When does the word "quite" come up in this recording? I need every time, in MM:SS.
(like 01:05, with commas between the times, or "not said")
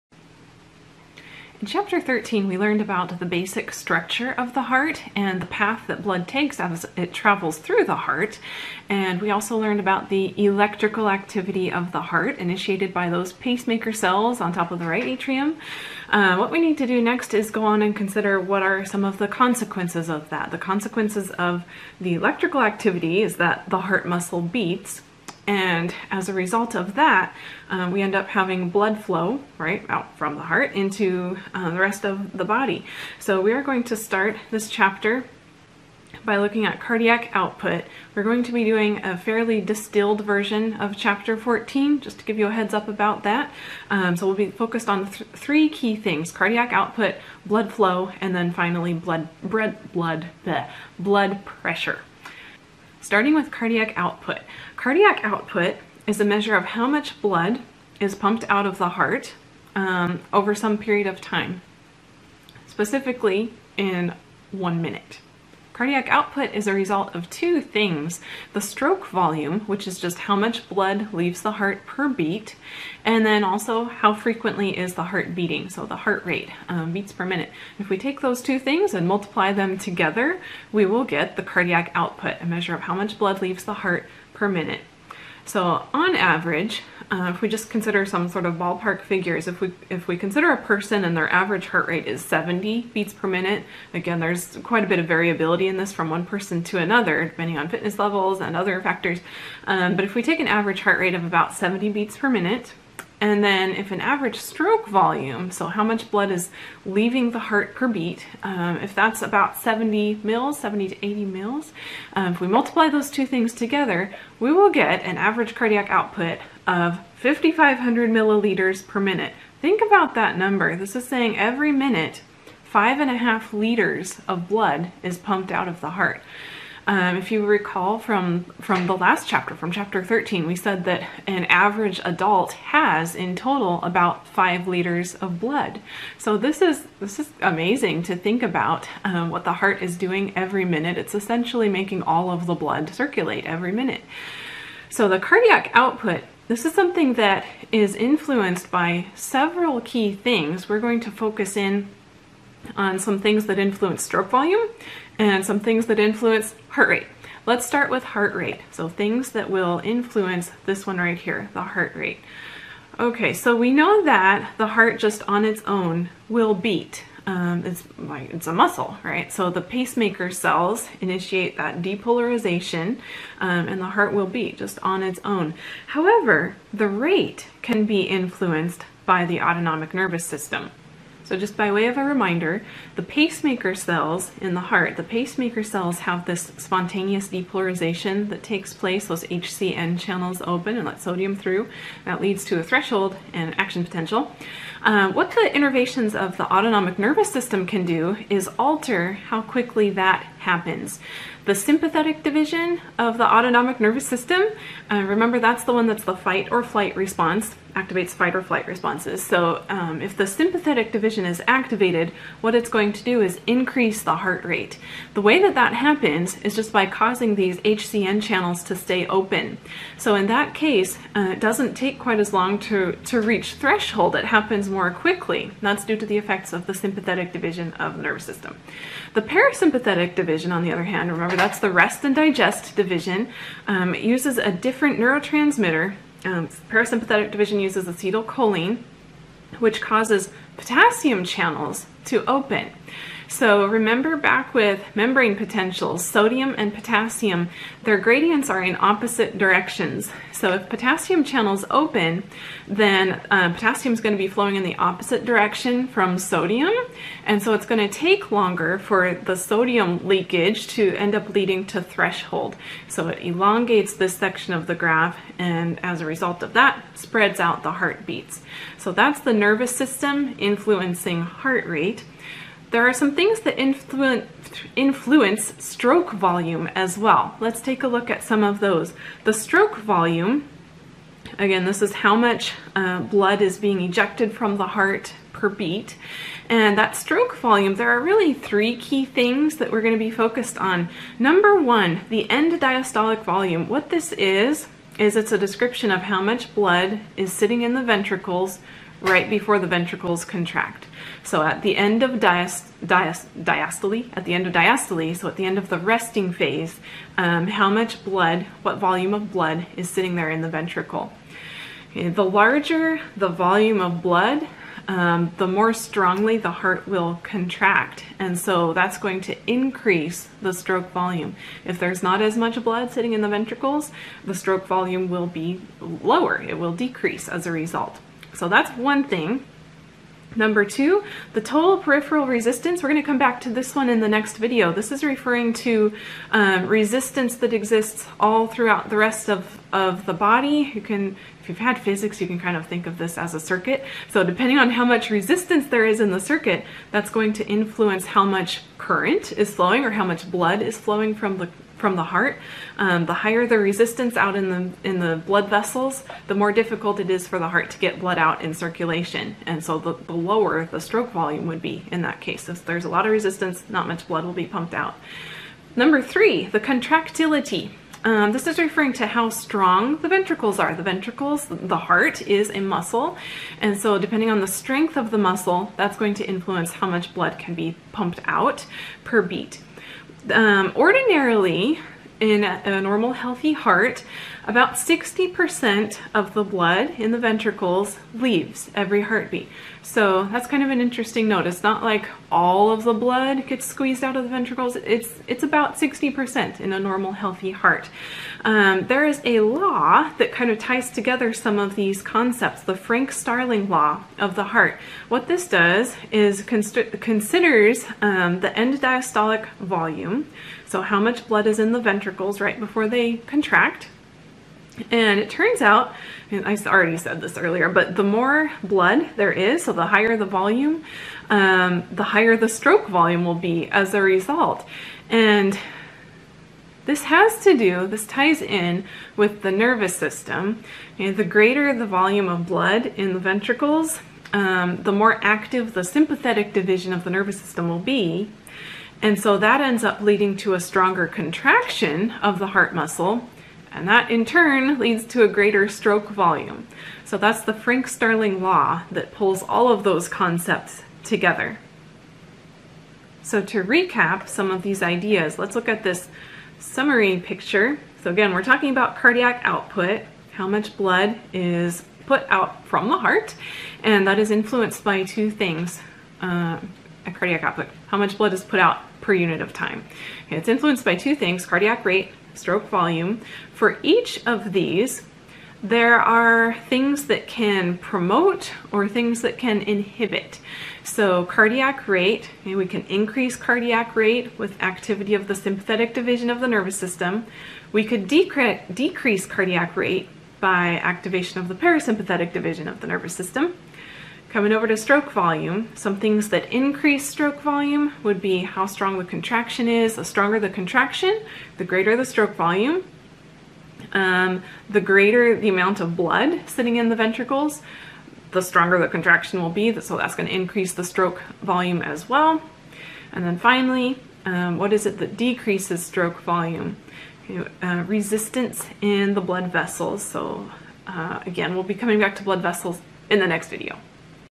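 01:34, 03:41.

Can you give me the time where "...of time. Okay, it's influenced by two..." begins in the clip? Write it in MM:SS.
07:49.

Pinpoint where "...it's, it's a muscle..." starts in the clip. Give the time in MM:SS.
02:47.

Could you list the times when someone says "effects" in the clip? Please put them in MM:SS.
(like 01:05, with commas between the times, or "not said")
03:46.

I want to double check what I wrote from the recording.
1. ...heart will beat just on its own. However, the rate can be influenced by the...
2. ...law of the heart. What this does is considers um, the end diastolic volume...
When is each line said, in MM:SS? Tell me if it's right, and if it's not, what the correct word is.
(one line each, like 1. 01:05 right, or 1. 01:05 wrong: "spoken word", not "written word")
1. 02:53 right
2. 06:43 right.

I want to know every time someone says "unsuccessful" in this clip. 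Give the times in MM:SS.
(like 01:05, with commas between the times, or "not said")
not said.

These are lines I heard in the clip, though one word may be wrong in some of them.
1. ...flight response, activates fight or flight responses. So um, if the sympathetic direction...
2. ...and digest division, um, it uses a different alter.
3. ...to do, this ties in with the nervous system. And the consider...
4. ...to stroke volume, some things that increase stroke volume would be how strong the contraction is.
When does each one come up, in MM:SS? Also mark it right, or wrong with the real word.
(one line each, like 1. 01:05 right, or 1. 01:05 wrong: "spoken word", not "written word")
1. 03:26 wrong: "division", not "direction"
2. 03:52 wrong: "neurotransmitter", not "alter"
3. 07:07 wrong: "greater", not "consider"
4. 08:14 right.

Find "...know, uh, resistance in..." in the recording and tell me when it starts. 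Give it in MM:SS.
08:37.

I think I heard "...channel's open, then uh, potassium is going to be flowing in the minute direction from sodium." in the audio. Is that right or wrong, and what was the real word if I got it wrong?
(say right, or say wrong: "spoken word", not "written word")
wrong: "opposite", not "minute".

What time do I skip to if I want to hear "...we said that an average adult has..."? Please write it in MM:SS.
02:10.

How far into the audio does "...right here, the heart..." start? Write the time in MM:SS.
02:40.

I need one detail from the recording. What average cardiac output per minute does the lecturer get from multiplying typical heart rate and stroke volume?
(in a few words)
5,500 milliliters per minute.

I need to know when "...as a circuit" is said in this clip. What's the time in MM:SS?
05:43.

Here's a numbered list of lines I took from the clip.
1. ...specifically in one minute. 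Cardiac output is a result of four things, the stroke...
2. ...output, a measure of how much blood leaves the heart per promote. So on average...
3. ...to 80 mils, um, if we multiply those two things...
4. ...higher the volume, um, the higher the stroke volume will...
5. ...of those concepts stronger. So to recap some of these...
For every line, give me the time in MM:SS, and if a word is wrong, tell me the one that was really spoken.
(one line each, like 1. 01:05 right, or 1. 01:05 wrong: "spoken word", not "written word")
1. 01:02 wrong: "two", not "four"
2. 01:21 wrong: "minute", not "promote"
3. 01:50 right
4. 06:59 right
5. 07:29 wrong: "together", not "stronger".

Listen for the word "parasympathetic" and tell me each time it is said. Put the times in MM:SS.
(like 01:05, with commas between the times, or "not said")
03:49, 03:56, 08:11.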